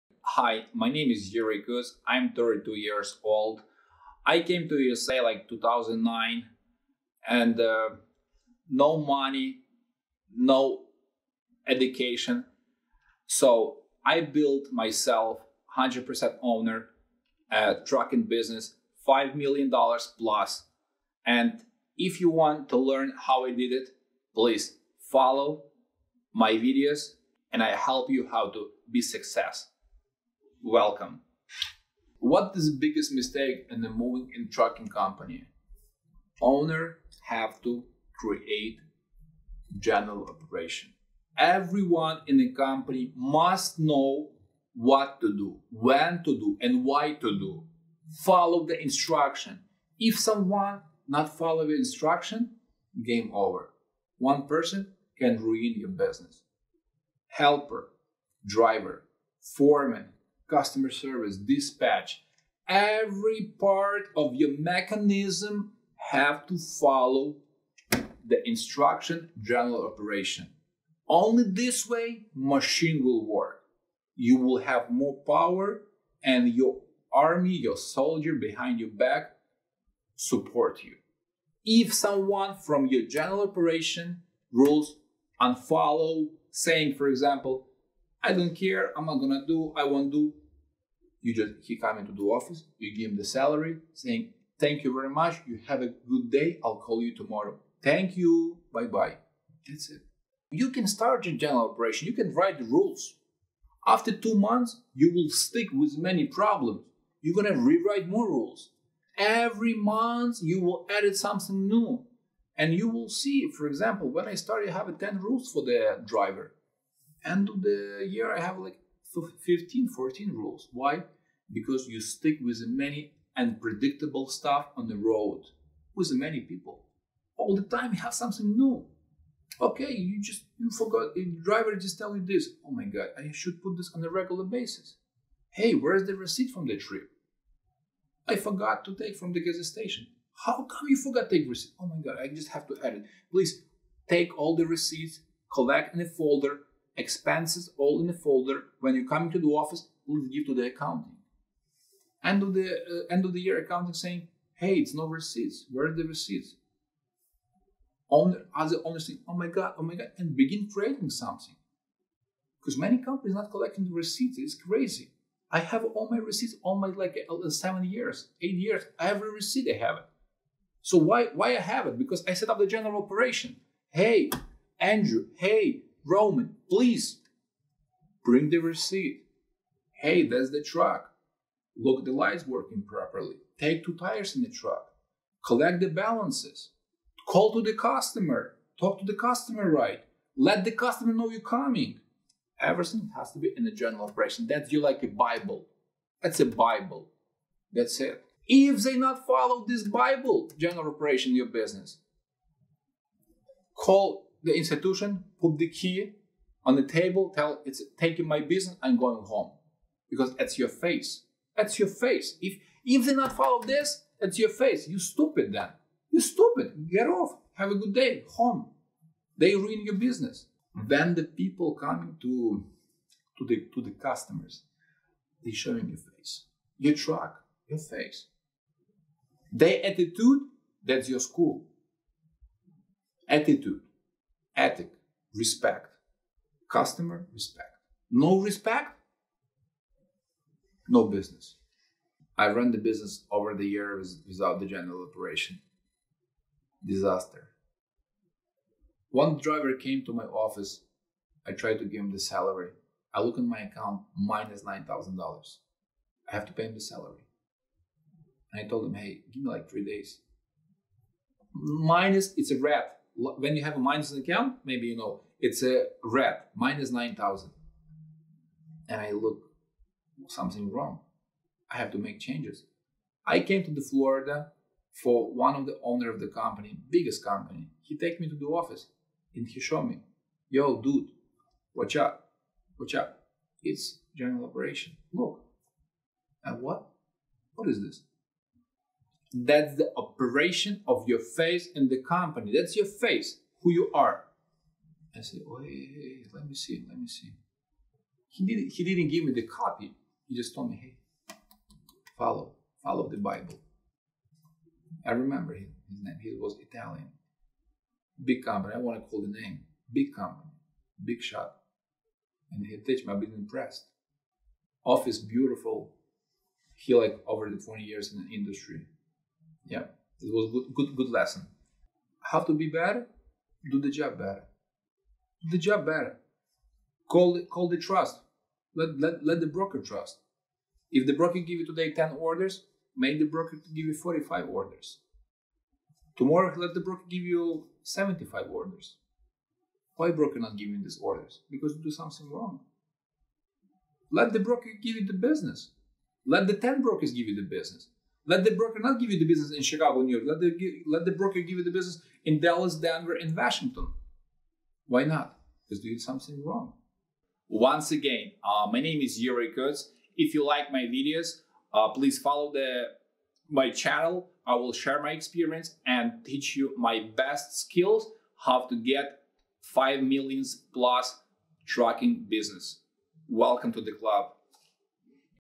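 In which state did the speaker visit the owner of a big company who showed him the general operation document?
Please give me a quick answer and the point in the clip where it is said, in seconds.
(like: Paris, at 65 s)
Florida, at 273 s.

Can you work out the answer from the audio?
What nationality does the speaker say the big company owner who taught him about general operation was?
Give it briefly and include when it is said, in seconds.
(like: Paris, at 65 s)
Italian, at 306 s.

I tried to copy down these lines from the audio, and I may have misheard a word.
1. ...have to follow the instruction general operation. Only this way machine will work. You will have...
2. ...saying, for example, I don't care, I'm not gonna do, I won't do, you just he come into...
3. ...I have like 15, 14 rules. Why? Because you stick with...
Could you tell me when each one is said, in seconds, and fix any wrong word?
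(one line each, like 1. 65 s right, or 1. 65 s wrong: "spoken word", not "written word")
1. 66 s right
2. 86 s right
3. 118 s right.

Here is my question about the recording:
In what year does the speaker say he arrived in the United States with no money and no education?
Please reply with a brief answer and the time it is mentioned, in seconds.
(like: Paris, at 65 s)
2009, at 5 s.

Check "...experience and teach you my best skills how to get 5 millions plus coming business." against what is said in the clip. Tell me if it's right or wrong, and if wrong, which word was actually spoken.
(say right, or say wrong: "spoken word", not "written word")
wrong: "trucking", not "coming".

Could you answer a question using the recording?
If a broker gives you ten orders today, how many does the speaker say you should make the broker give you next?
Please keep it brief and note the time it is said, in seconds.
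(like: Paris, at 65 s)
45, at 333 s.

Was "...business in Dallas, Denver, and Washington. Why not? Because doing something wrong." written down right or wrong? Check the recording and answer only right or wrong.
right.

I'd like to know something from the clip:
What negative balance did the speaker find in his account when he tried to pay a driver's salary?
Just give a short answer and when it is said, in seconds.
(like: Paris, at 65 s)
$9,000, at 254 s.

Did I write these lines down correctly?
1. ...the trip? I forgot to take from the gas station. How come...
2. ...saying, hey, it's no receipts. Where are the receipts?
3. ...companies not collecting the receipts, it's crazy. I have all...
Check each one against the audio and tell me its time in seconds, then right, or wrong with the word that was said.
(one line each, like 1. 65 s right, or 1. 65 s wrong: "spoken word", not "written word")
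1. 136 s right
2. 153 s right
3. 162 s right.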